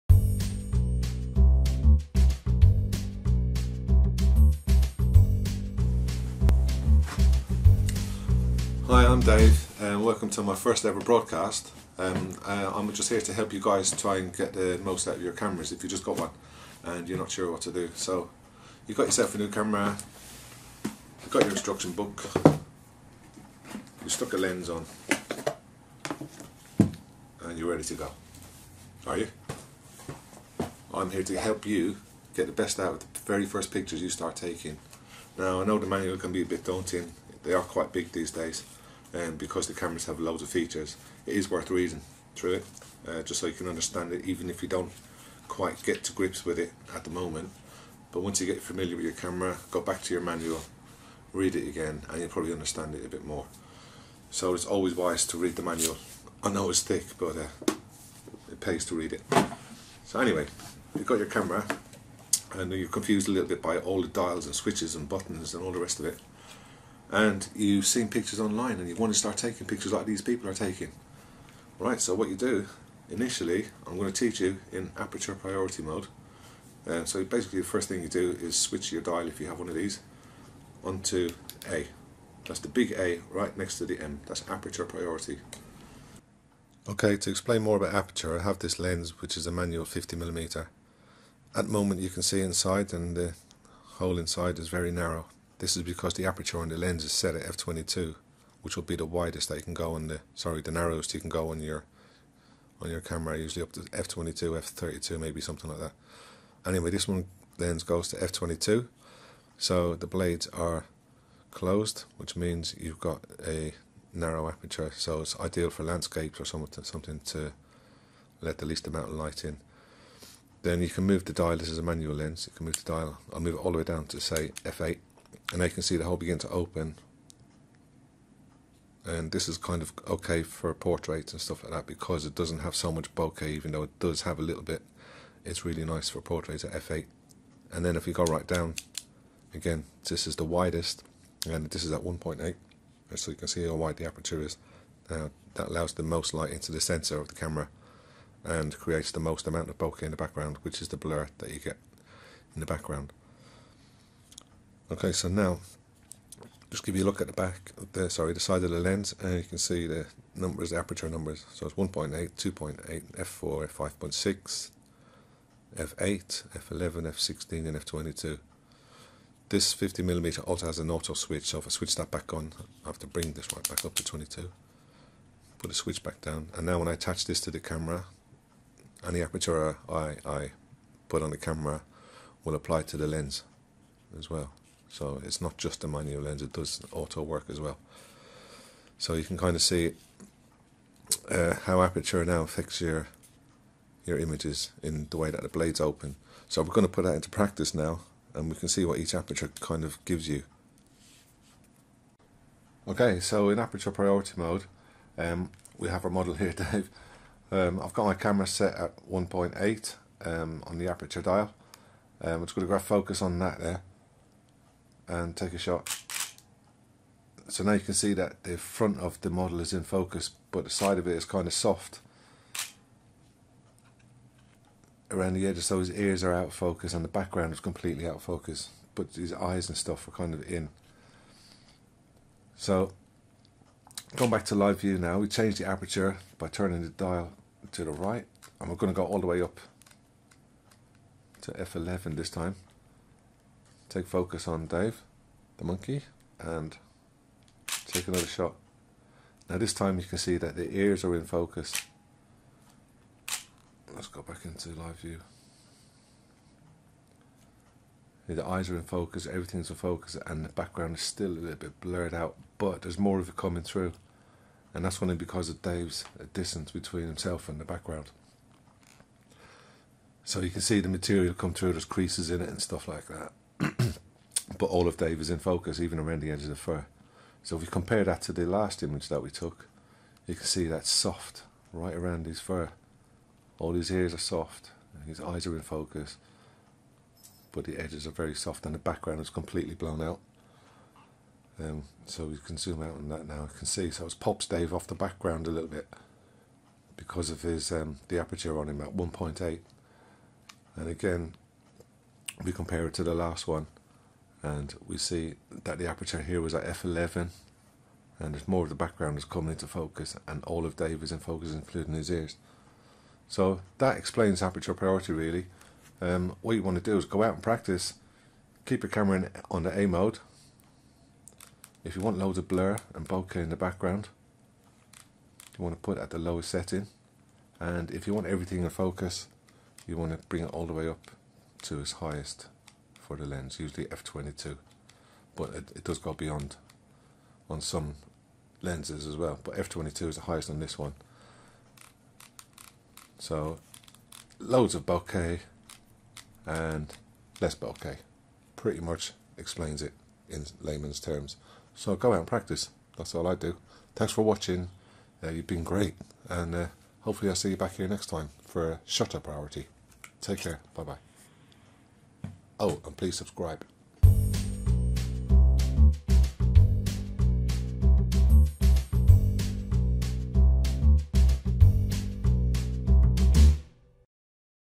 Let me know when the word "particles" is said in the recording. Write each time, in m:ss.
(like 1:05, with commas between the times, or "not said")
not said.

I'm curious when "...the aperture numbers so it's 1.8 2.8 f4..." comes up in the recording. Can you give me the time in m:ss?
2:40.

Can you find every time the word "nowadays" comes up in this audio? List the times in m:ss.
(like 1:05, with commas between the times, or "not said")
not said.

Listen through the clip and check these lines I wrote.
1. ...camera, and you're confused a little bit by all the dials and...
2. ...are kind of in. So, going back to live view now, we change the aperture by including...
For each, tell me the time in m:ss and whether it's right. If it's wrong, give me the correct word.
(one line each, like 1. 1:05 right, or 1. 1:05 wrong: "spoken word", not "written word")
1. 1:01 right
2. 3:50 wrong: "turning", not "including".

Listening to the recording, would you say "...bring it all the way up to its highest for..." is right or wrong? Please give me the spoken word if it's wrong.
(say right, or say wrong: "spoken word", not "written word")
right.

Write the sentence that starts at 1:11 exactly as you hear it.
Right, so what you do, initially, I'm going to teach you in aperture priority mode.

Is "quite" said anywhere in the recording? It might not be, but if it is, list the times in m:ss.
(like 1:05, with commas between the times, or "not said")
0:37, 0:45.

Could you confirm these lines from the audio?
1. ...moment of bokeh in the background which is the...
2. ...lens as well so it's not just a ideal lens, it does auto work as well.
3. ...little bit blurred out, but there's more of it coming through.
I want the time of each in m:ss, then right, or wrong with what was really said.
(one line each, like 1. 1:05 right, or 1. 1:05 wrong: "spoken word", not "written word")
1. 2:29 wrong: "amount", not "moment"
2. 3:03 wrong: "manual", not "ideal"
3. 4:21 right.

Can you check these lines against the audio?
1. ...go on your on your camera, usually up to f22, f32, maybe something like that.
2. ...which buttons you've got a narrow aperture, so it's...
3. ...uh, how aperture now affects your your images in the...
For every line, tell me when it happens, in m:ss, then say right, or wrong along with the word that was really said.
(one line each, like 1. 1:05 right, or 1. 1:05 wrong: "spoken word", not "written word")
1. 1:41 right
2. 1:52 wrong: "means", not "buttons"
3. 3:11 right.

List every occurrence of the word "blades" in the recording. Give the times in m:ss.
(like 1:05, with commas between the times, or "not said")
1:50, 3:15.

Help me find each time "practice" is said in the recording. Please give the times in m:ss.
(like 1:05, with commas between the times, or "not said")
3:17, 5:17, 5:52.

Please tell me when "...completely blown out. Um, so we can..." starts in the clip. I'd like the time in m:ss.
4:49.